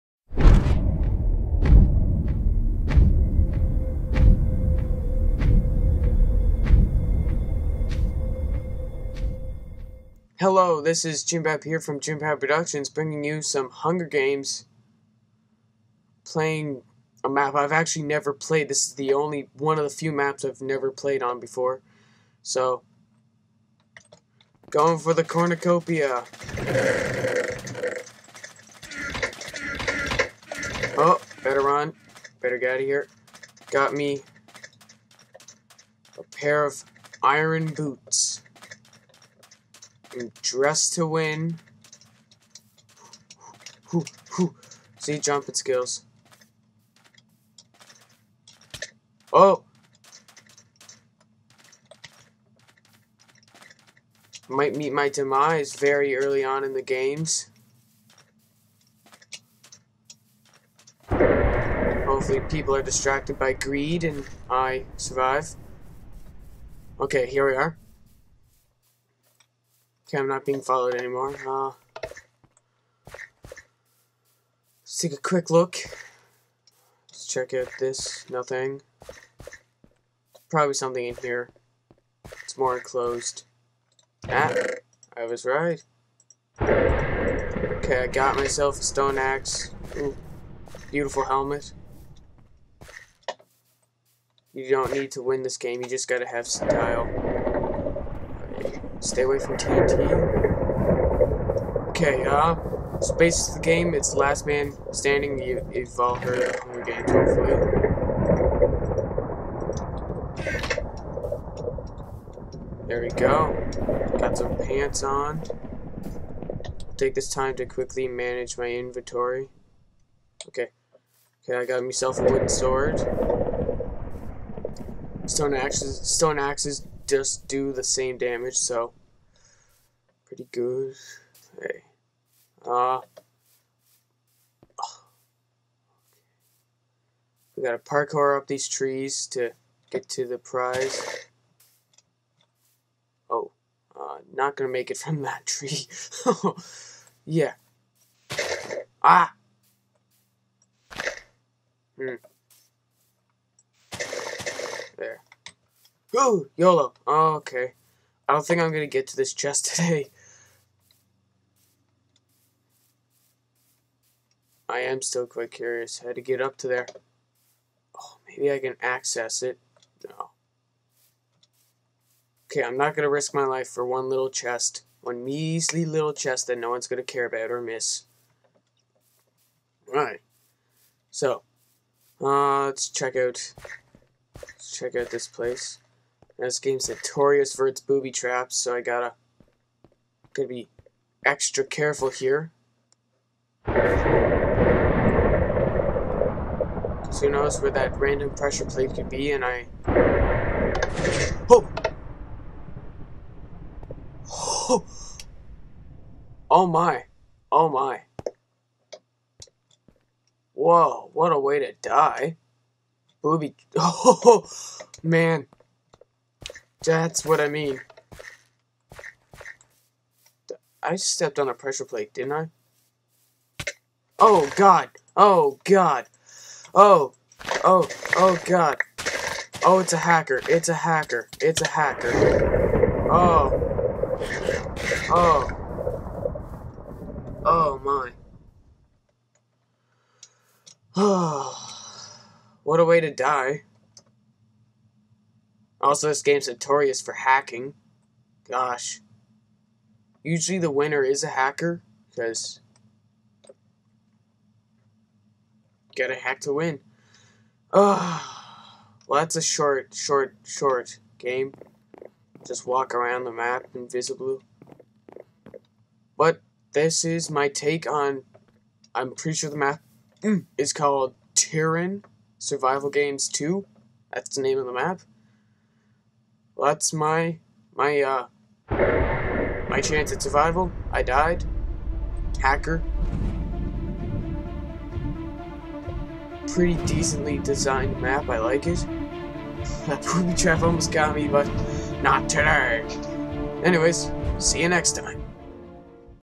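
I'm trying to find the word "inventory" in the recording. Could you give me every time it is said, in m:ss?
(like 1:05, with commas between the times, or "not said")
1:58.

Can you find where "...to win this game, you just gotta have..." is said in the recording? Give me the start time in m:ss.
1:35.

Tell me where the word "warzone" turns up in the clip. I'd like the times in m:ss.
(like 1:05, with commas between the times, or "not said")
not said.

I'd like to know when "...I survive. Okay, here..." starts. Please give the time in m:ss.
1:04.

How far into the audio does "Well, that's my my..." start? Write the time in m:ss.
4:36.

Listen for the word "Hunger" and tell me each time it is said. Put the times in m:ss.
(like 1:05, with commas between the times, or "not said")
0:13, 1:46.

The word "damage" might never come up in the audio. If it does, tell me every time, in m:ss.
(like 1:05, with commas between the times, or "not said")
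2:08.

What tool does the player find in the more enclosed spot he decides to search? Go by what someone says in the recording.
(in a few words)
stone axe.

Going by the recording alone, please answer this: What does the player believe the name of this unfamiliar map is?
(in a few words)
Tyrann Survival Games 2.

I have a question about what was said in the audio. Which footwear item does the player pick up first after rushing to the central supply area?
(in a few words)
iron boots.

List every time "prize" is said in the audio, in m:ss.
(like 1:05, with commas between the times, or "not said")
2:20.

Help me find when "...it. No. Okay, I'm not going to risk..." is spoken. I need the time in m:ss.
2:49.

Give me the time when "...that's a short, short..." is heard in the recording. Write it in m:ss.
4:19.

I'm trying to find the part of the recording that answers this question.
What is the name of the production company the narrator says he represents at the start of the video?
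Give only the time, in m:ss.
0:11.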